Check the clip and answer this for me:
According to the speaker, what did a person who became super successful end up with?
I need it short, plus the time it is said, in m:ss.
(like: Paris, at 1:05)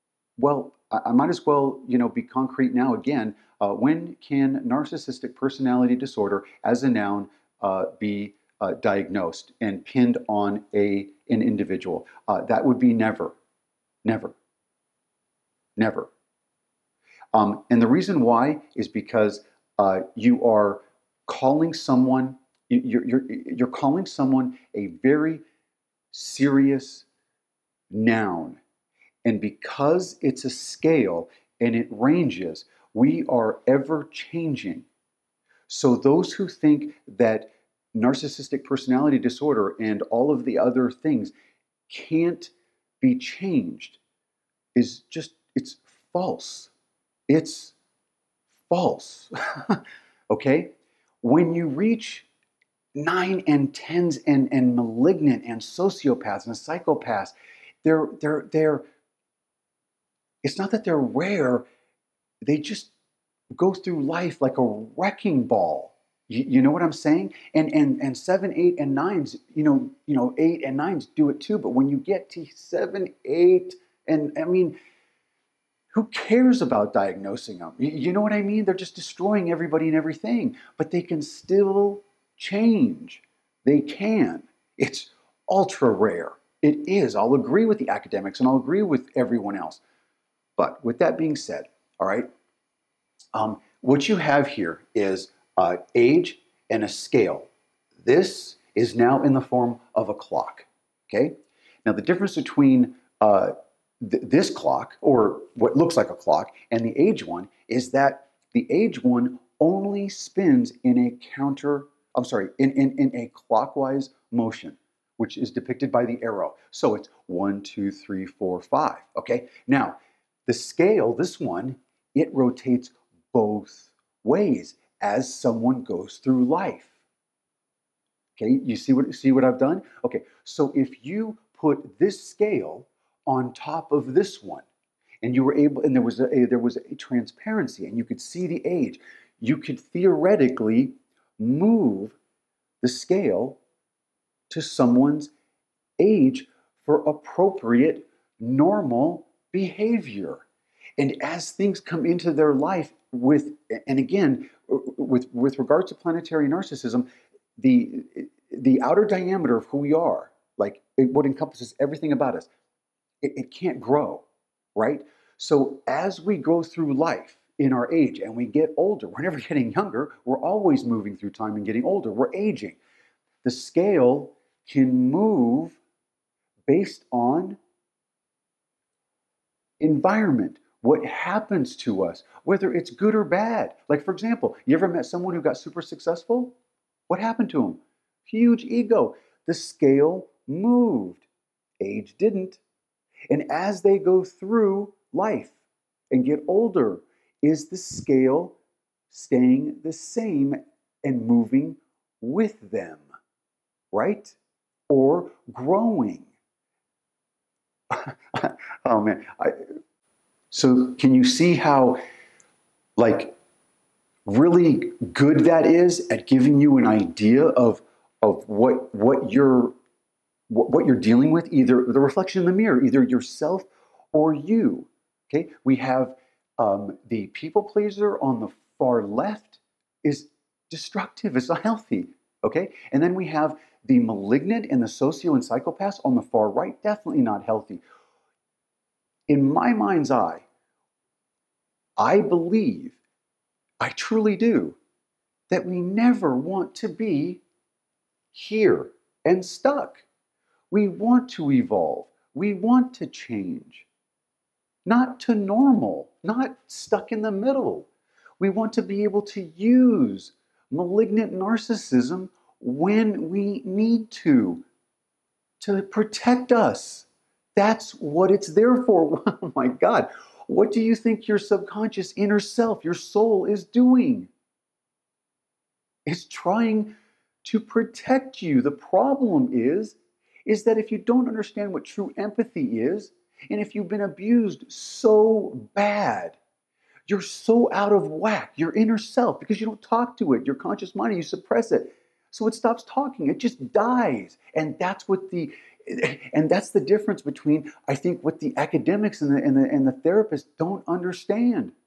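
huge ego, at 3:08.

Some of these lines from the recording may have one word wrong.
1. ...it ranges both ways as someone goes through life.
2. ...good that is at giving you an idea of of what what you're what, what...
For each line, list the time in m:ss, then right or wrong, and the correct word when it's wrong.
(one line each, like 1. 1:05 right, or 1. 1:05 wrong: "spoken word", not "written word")
1. 2:02 wrong: "rotates", not "ranges"
2. 3:35 right.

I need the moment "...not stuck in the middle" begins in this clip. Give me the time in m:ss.
4:16.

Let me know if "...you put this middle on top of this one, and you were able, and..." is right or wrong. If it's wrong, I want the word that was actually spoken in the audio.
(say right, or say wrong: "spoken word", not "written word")
wrong: "scale", not "middle".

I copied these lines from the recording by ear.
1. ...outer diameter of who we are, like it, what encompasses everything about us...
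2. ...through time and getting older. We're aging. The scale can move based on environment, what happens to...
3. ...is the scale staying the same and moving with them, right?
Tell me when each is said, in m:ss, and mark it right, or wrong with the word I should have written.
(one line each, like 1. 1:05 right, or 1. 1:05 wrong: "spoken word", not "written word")
1. 2:38 right
2. 2:51 right
3. 3:17 right.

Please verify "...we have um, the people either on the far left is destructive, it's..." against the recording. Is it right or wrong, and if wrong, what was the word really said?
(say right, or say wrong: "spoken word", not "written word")
wrong: "pleaser", not "either".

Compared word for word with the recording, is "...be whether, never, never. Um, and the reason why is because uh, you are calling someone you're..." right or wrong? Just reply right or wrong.
wrong.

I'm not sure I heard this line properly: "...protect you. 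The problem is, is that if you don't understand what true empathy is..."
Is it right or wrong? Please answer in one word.
right.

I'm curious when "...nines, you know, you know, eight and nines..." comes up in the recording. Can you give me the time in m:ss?
1:08.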